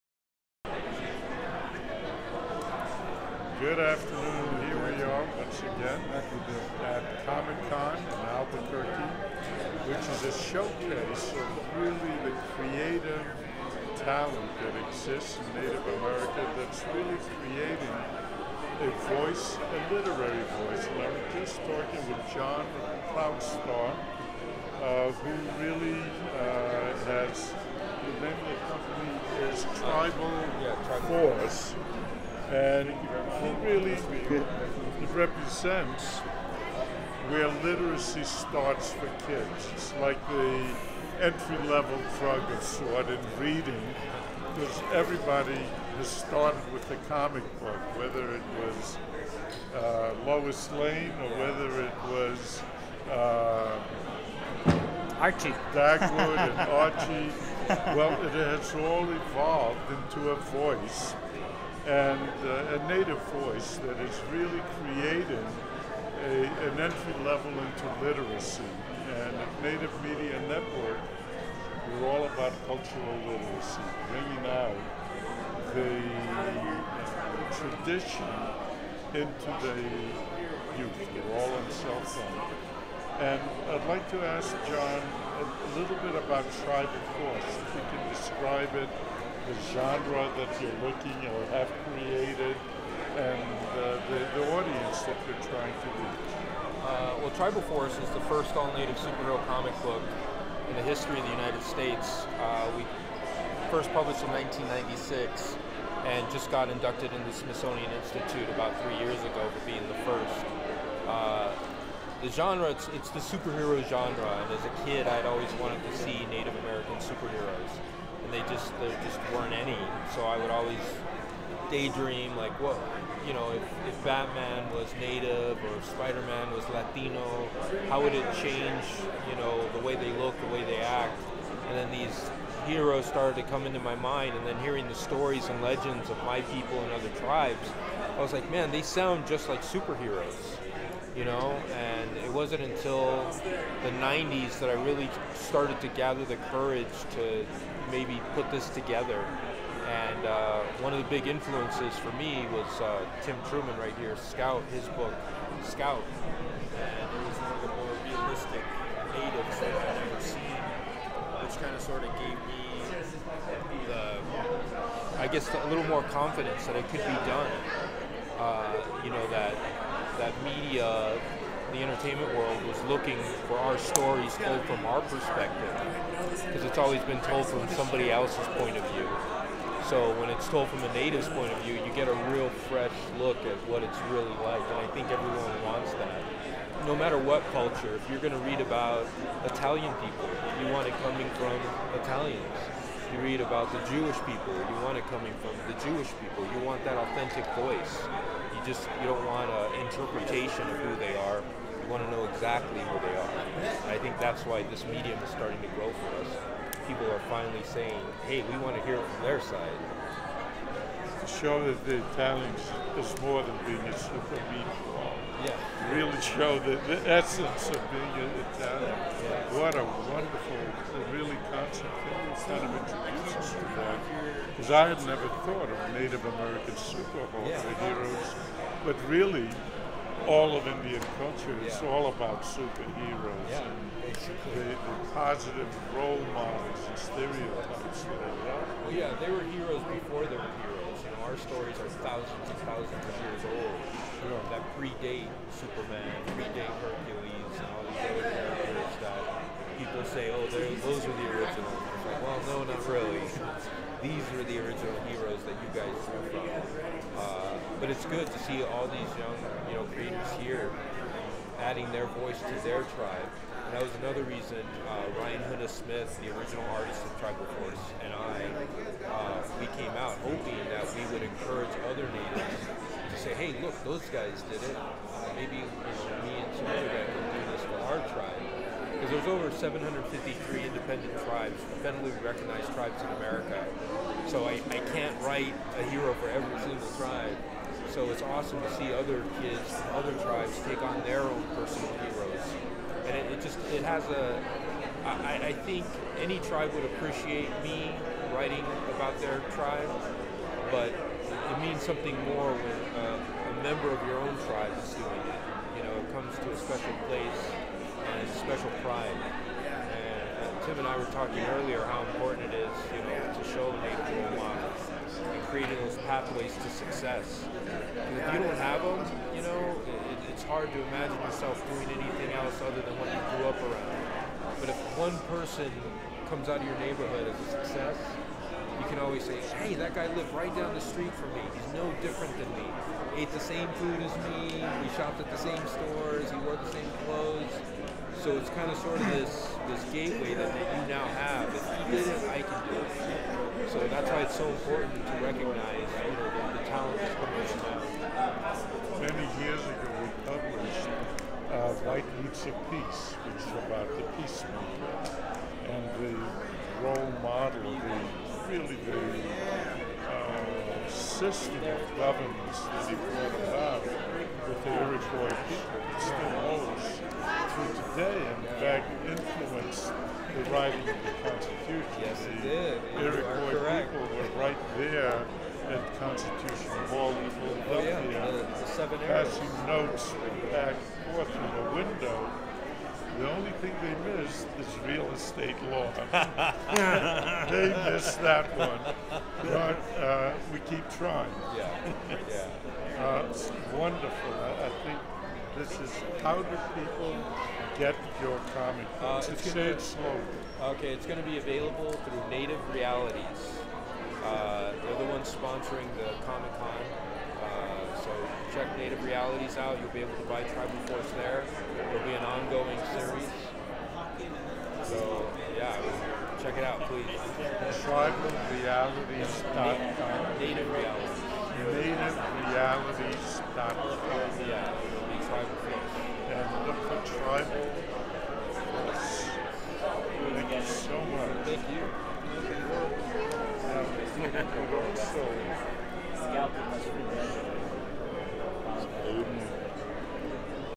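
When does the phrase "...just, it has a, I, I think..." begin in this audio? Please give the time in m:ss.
4:53.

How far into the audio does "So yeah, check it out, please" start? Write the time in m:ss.
6:54.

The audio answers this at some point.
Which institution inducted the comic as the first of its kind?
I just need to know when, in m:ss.
1:47.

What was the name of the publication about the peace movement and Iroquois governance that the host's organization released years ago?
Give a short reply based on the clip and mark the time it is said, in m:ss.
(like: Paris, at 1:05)
White Roots of Peace, at 5:51.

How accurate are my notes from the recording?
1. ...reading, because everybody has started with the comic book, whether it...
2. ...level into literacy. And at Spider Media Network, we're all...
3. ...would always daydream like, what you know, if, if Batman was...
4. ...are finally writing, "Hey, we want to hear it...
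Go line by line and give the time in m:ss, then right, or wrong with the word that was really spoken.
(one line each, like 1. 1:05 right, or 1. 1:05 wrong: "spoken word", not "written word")
1. 0:43 right
2. 1:07 wrong: "Native", not "Spider"
3. 2:00 right
4. 3:27 wrong: "saying", not "writing".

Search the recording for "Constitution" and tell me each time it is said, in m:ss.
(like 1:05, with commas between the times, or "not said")
6:11, 6:15.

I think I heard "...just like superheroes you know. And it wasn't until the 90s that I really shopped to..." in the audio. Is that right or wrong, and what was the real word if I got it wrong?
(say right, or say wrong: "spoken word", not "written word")
wrong: "started", not "shopped".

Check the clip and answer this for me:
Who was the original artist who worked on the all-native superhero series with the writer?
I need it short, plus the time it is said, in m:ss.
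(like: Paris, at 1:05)
Ryan Huna Smith, at 4:25.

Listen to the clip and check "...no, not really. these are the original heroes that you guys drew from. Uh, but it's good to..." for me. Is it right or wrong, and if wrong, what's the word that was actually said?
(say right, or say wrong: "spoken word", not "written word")
right.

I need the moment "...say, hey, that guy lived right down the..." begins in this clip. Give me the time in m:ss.
5:29.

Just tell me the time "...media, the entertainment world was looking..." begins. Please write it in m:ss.
2:50.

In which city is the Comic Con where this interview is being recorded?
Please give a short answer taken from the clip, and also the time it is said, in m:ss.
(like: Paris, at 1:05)
Albuquerque, at 0:08.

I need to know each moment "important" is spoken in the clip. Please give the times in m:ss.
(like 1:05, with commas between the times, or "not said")
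5:12, 5:44.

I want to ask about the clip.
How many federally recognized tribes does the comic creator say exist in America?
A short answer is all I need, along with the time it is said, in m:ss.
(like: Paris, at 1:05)
753, at 4:39.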